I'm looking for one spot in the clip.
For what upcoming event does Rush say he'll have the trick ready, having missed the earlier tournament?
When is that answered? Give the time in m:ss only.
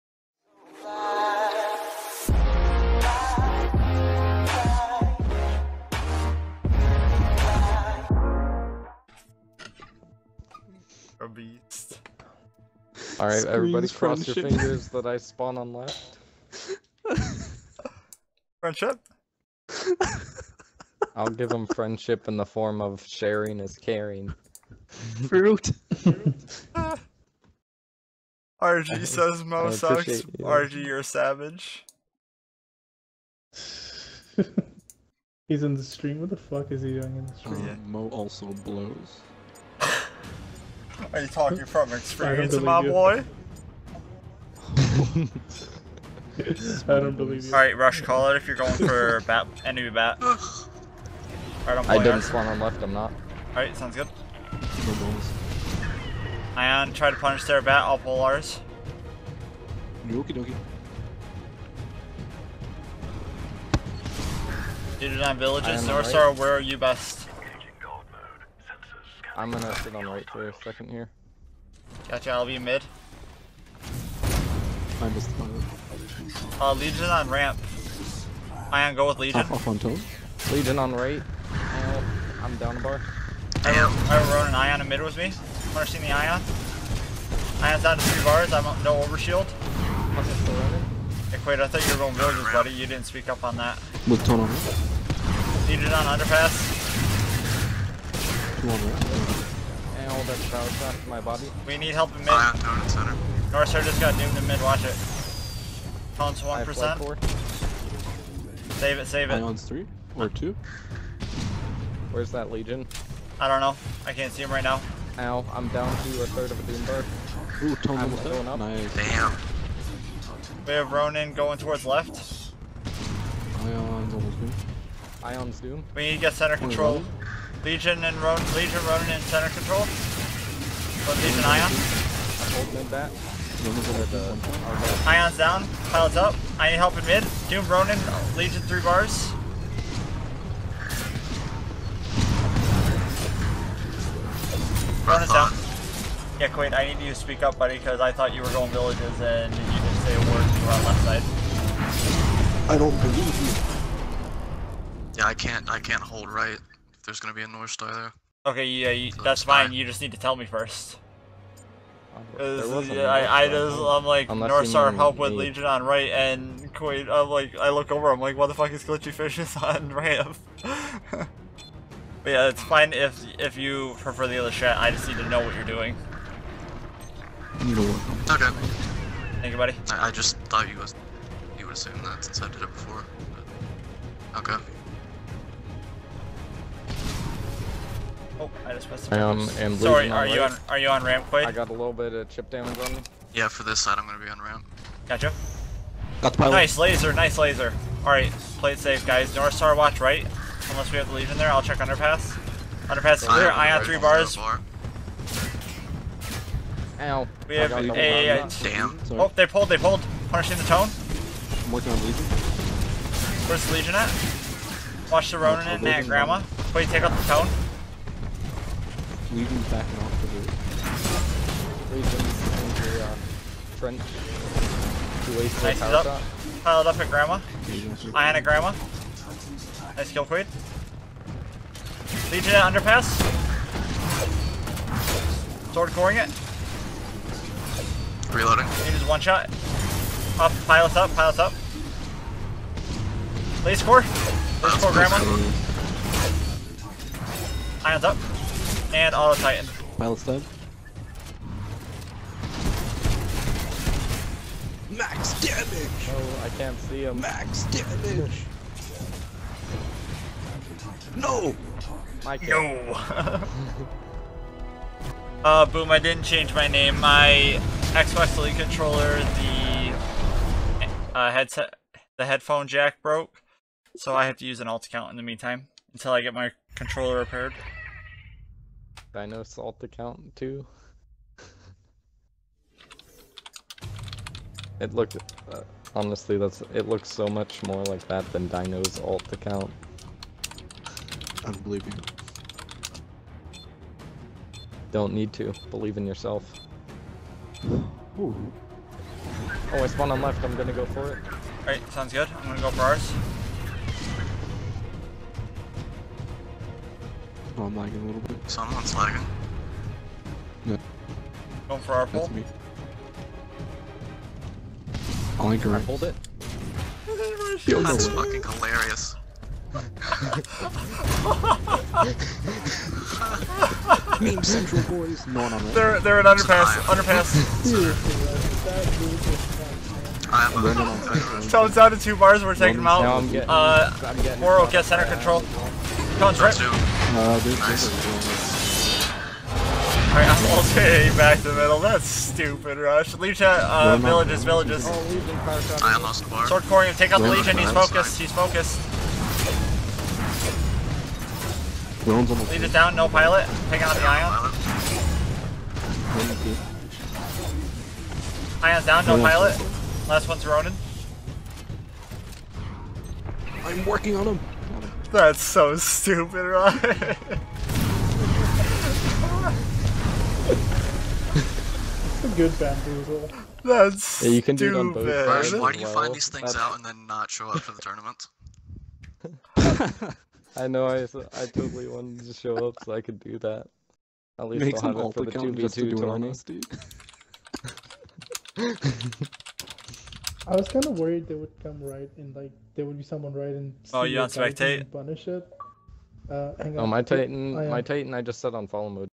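6:25.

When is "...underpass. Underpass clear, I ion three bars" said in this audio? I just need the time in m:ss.
3:21.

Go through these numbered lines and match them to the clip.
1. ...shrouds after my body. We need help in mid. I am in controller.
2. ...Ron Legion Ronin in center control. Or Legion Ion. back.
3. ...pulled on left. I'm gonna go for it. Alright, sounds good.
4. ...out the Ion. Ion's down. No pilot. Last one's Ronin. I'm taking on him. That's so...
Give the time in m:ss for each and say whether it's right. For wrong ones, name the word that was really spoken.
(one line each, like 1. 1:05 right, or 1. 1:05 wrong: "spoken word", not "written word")
1. 1:40 wrong: "center", not "controller"
2. 2:08 right
3. 4:59 wrong: "spawned", not "pulled"
4. 5:53 wrong: "working", not "taking".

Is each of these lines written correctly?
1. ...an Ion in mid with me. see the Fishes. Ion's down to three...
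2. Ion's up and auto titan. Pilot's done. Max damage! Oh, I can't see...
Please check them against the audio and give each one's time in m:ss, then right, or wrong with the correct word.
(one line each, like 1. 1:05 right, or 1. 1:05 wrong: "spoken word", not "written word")
1. 1:24 wrong: "Ion", not "Fishes"
2. 4:07 right.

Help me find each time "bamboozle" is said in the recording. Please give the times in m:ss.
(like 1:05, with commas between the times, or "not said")
6:12.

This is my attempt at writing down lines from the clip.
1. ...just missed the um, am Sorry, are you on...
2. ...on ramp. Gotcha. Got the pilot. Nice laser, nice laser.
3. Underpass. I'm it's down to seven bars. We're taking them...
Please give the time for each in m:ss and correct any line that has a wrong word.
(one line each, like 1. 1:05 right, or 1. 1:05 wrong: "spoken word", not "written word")
1. 3:08 right
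2. 3:14 right
3. 5:26 wrong: "two", not "seven".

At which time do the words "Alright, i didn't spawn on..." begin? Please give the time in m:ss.
0:50.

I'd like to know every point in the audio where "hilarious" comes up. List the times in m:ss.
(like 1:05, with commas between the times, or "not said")
5:18.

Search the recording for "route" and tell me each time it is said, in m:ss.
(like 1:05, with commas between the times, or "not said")
3:40.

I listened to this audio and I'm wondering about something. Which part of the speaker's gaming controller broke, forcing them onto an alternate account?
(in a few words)
headphone jack.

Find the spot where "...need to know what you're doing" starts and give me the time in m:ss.
2:55.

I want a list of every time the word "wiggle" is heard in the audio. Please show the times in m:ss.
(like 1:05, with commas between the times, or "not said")
not said.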